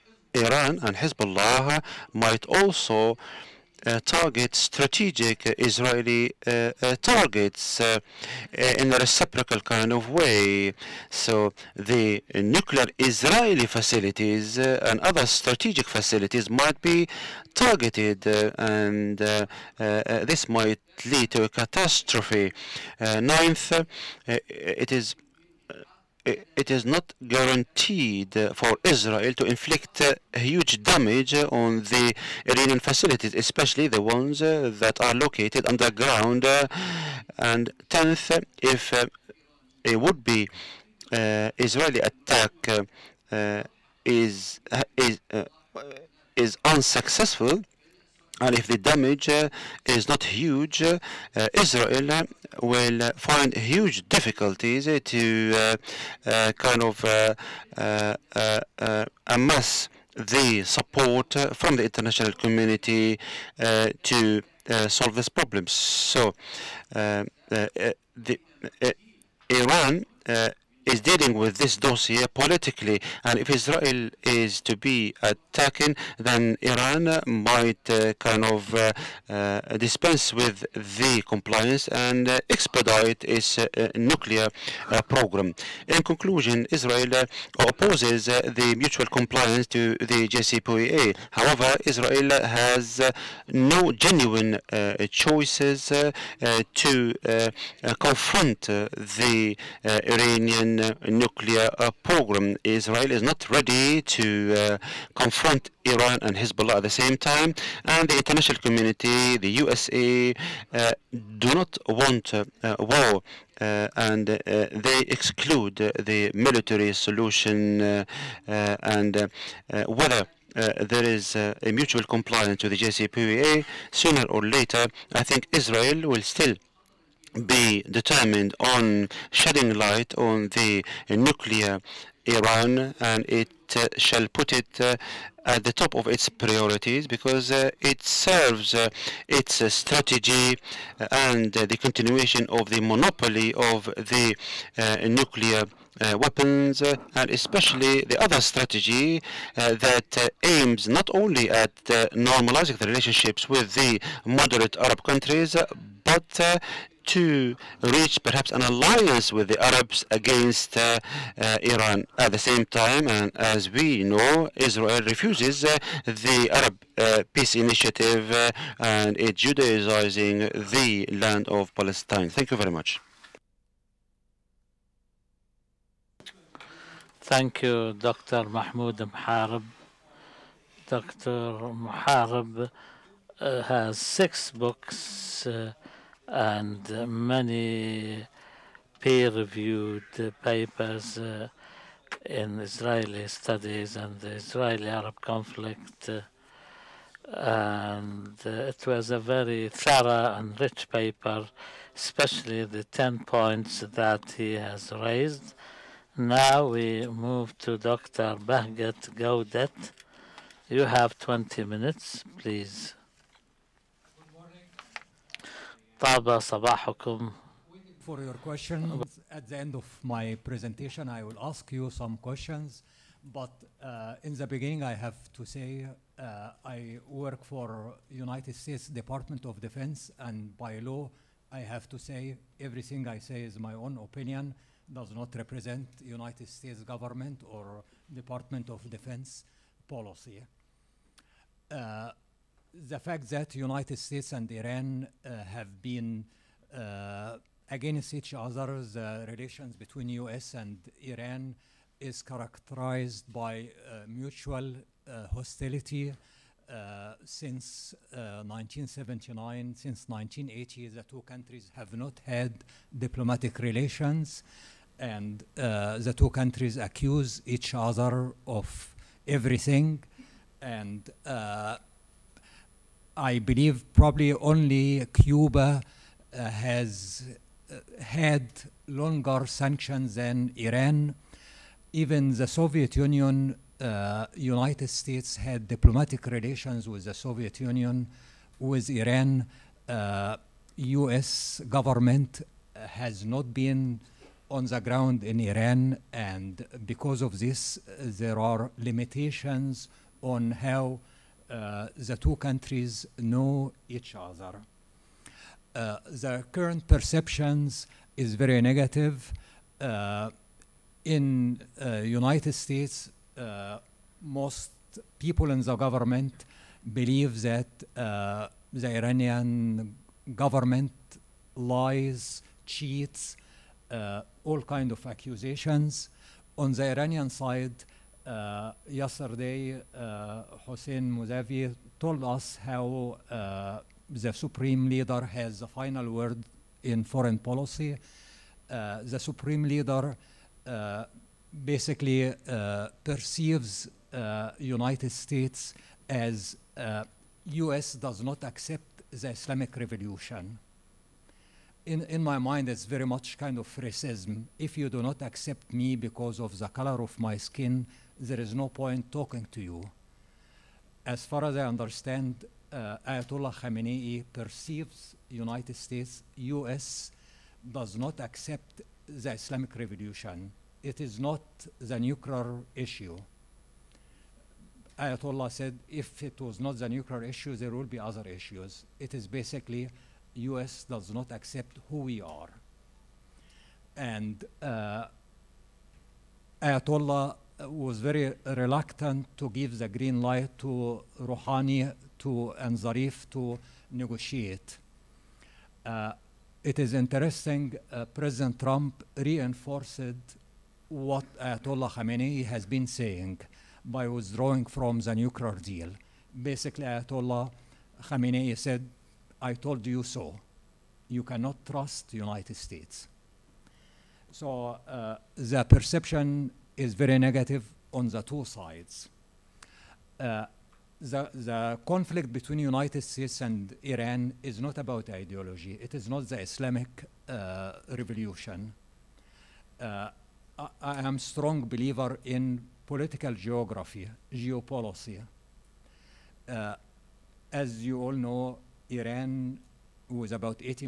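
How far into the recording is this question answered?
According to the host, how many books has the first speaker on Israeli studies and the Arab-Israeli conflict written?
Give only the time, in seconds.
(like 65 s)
183 s.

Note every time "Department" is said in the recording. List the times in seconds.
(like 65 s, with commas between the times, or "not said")
228 s, 238 s.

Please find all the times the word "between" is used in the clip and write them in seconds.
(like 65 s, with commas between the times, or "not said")
249 s, 422 s.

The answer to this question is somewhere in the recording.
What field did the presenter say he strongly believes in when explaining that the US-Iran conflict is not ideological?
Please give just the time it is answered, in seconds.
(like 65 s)
432 s.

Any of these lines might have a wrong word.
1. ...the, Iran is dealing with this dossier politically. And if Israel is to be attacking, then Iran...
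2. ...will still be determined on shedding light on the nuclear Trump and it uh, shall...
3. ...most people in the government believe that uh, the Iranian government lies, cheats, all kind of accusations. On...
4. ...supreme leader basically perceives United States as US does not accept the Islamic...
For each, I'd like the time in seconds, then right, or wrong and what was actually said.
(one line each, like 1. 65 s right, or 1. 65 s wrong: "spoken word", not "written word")
1. 66 s right
2. 126 s wrong: "Iran", not "Trump"
3. 314 s right
4. 339 s right.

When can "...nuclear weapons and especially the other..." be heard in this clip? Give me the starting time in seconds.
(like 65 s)
145 s.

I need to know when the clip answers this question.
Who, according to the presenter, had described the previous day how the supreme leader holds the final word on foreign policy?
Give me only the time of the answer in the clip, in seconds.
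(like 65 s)
330 s.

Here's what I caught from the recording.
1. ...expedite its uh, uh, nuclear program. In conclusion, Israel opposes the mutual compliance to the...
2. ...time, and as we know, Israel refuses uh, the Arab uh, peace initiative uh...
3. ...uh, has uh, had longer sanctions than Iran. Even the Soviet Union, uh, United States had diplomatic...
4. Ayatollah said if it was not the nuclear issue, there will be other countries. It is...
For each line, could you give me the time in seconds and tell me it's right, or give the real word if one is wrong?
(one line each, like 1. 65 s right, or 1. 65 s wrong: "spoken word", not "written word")
1. 82 s right
2. 162 s right
3. 275 s right
4. 374 s wrong: "issues", not "countries".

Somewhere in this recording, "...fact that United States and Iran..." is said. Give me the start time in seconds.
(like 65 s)
242 s.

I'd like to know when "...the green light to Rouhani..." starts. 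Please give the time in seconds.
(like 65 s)
389 s.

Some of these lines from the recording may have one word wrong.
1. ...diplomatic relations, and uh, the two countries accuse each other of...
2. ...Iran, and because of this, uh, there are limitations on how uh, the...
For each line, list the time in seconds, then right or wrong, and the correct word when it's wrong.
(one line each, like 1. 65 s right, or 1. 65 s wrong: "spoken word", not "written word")
1. 262 s right
2. 295 s right.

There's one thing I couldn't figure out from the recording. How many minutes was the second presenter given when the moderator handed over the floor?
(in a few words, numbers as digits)
20.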